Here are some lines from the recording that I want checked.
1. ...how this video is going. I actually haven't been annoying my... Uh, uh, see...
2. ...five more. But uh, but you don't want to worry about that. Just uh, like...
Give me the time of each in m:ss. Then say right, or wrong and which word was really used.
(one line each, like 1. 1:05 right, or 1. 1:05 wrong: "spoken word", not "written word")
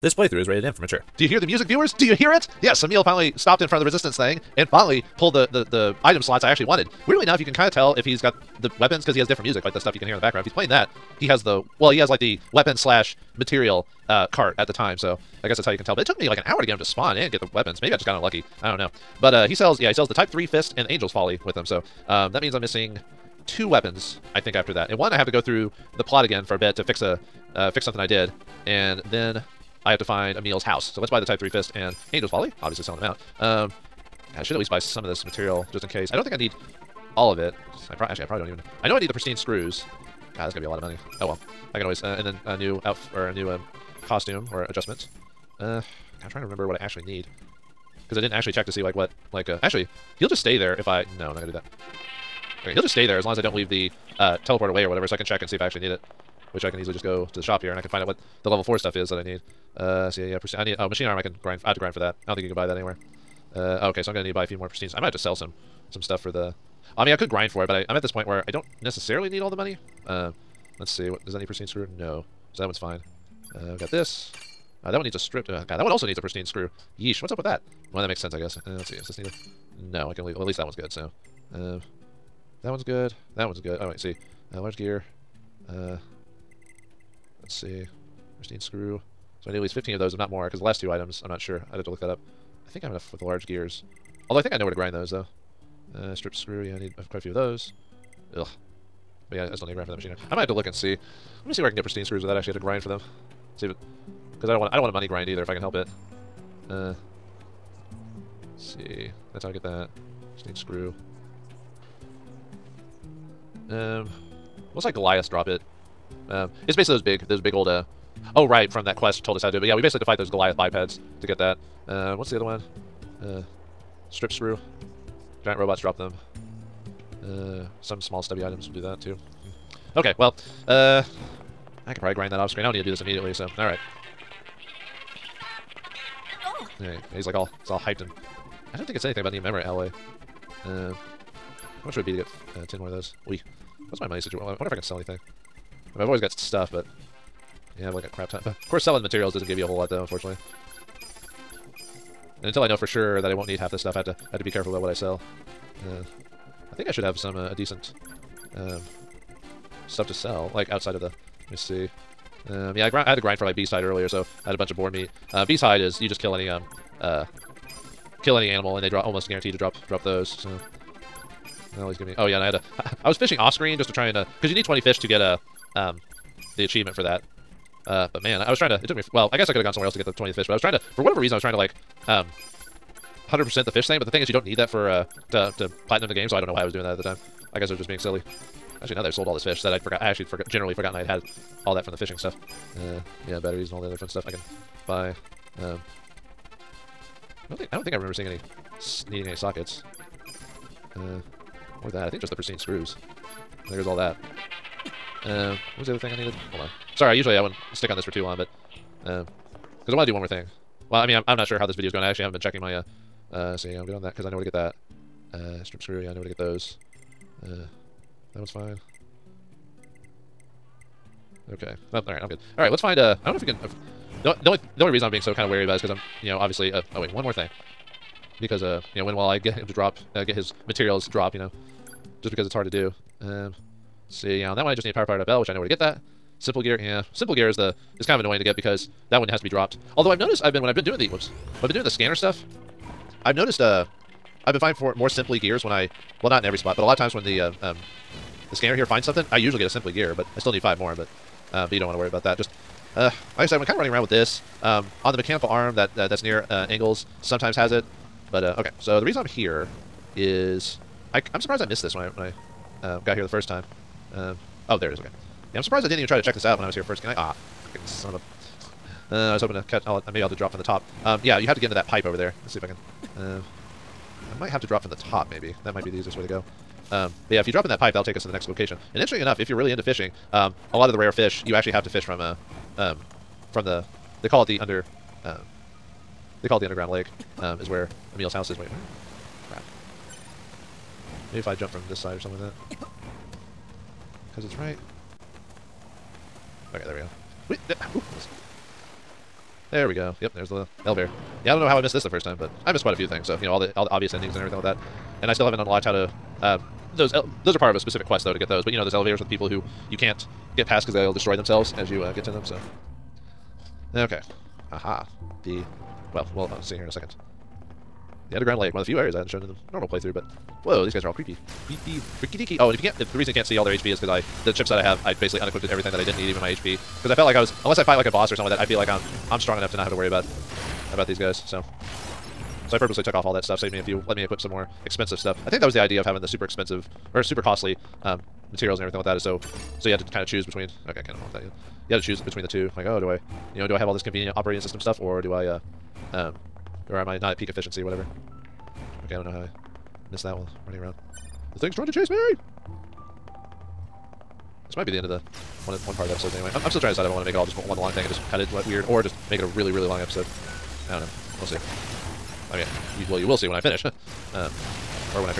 1. 3:31 wrong: "checking", not "annoying"
2. 4:10 right.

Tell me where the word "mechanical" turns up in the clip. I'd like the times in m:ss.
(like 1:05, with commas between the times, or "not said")
4:15.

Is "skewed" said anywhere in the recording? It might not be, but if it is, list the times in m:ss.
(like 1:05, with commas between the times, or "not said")
not said.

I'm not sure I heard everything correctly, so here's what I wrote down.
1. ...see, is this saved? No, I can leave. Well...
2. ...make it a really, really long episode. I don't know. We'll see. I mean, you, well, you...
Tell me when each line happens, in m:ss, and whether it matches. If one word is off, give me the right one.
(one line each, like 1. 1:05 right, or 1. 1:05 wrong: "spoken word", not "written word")
1. 1:18 wrong: "needed", not "saved"
2. 5:59 right.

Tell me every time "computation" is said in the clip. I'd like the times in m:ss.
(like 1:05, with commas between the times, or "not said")
not said.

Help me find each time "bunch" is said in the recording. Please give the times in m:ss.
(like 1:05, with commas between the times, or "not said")
2:44.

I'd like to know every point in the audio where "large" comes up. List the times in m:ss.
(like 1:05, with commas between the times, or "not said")
1:24, 1:33.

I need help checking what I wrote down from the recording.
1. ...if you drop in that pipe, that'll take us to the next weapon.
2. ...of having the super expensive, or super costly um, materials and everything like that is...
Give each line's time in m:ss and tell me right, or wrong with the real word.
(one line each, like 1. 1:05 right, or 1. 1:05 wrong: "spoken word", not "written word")
1. 4:37 wrong: "location", not "weapon"
2. 5:36 right.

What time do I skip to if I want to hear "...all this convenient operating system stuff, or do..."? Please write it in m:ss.
5:43.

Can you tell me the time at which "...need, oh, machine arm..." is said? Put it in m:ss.
1:00.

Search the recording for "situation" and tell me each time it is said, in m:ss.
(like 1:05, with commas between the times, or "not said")
2:24.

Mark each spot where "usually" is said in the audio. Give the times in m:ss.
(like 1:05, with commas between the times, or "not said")
3:27, 4:09.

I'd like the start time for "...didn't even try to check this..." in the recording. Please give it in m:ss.
4:25.